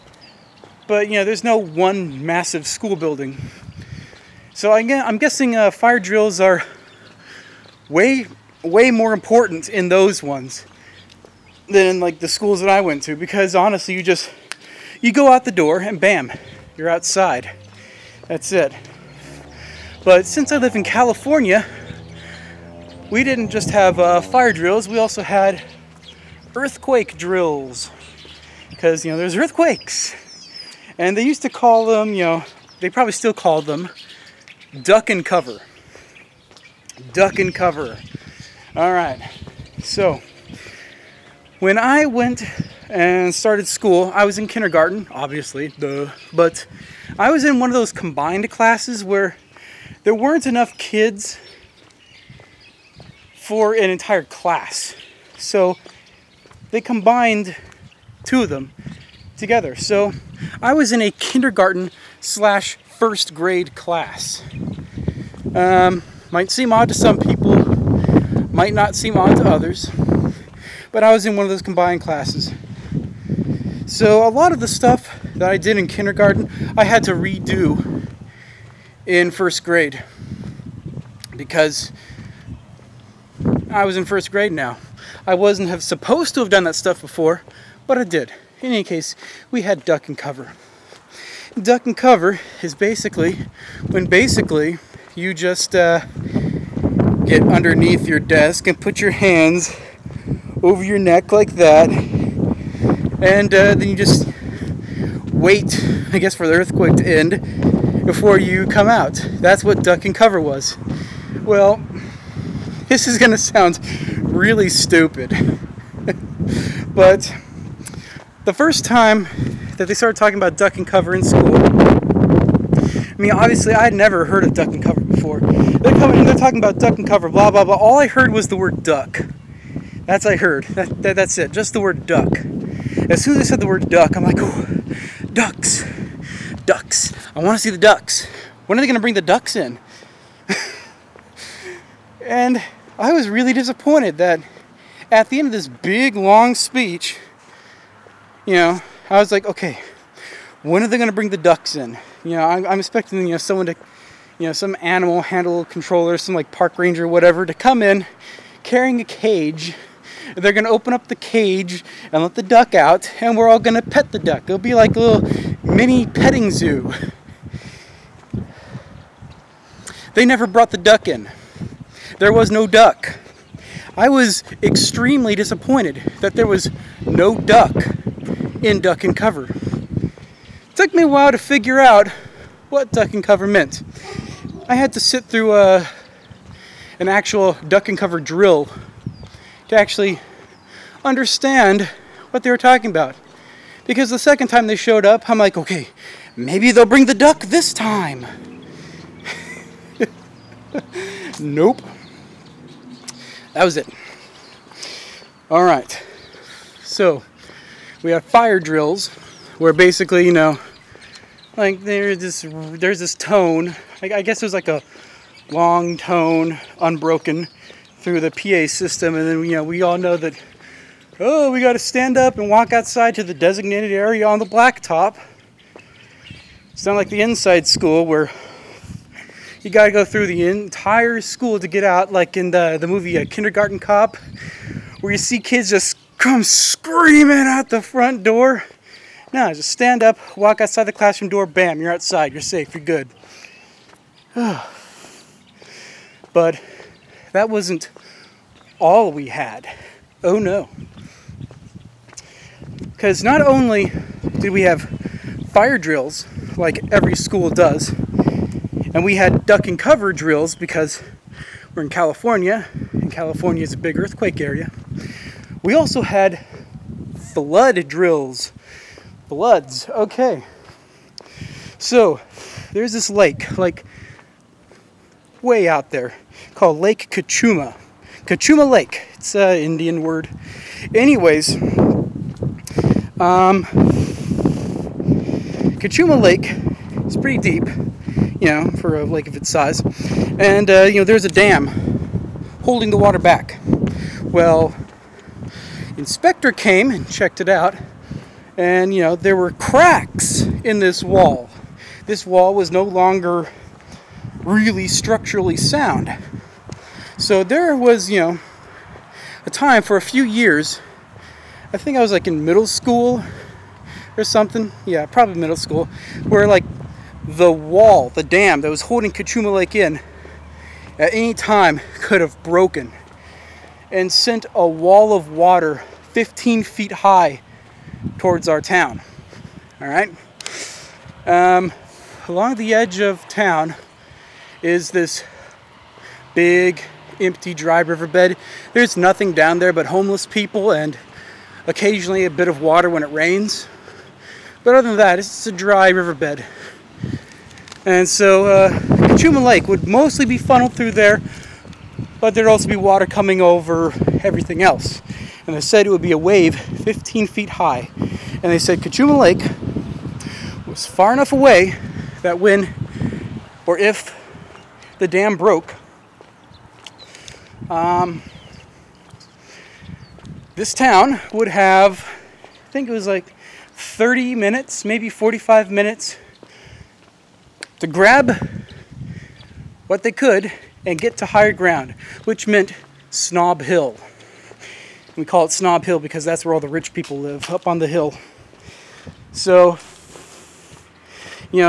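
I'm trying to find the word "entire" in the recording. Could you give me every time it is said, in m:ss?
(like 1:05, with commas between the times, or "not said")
0:53, 3:50.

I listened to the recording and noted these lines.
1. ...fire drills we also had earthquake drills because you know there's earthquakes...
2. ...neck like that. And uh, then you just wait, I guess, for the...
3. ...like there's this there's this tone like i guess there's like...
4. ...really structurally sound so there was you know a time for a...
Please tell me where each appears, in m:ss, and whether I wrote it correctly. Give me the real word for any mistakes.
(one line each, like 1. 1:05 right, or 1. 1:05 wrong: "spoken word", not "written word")
1. 0:24 right
2. 1:40 right
3. 3:31 right
4. 5:04 right.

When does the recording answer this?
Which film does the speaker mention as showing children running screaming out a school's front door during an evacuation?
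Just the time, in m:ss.
3:53.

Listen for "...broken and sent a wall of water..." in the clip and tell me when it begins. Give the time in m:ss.
5:22.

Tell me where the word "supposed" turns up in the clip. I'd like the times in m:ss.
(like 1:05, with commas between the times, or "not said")
1:25.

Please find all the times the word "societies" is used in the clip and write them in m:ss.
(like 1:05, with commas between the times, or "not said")
not said.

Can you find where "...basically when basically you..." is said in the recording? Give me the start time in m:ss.
1:32.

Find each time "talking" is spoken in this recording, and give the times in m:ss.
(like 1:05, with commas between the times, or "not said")
2:00, 2:06, 3:12.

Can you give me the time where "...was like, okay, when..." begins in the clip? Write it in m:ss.
2:29.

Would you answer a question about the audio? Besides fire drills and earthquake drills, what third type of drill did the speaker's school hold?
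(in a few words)
flood drills.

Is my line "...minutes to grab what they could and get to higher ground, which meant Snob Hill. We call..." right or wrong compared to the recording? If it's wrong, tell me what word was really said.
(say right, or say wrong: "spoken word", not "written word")
right.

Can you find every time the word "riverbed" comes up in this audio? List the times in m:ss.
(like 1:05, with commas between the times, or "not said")
5:37, 5:45.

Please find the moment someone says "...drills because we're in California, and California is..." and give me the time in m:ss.
4:20.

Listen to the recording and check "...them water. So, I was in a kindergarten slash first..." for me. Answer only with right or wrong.
wrong.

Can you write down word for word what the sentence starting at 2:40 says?
They're gonna open up the cage and let the duck out, and we're all gonna pet the duck.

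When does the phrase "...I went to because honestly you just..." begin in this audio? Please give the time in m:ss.
0:12.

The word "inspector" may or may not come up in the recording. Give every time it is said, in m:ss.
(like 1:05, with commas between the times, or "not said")
4:55.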